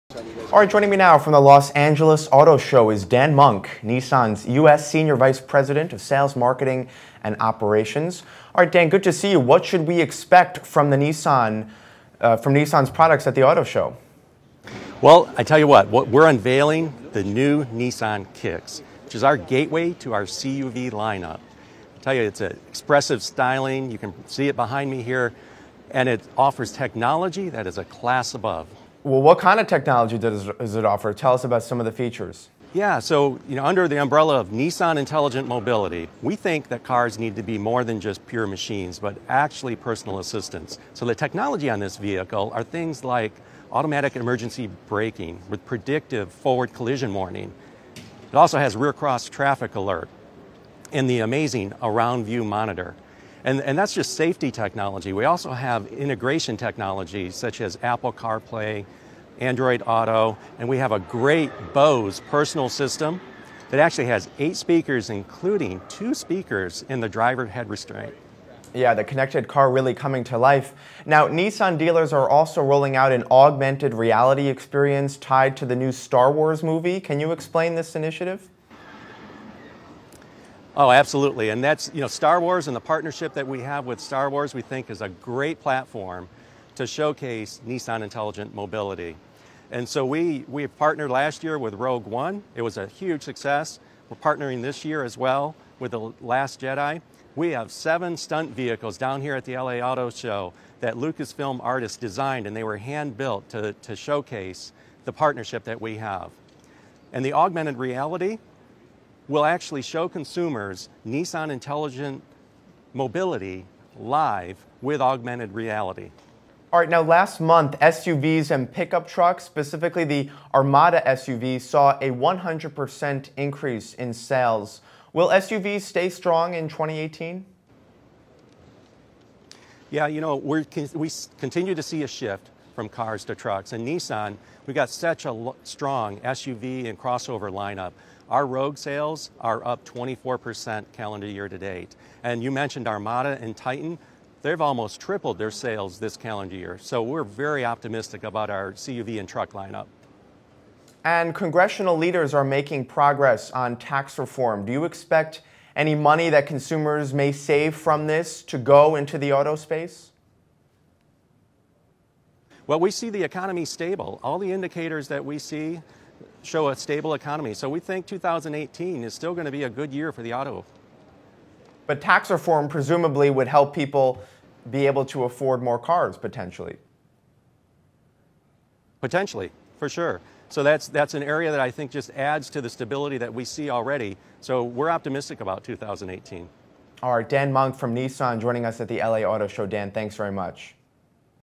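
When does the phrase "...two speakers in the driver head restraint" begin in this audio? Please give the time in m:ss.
1:05.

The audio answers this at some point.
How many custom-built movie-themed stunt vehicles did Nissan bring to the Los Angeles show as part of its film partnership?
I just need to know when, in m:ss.
1:37.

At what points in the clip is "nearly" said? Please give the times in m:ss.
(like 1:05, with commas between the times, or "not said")
not said.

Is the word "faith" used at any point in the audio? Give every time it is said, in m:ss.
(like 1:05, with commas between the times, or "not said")
not said.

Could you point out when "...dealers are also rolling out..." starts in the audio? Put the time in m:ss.
1:11.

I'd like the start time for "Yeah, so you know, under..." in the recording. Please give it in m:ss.
0:32.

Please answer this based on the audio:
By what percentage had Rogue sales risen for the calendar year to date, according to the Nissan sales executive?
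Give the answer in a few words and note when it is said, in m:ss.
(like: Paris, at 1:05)
24%, at 2:19.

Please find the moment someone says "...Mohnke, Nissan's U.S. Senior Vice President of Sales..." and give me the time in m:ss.
0:03.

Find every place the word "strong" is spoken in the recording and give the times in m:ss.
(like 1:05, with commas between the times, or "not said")
2:06, 2:15.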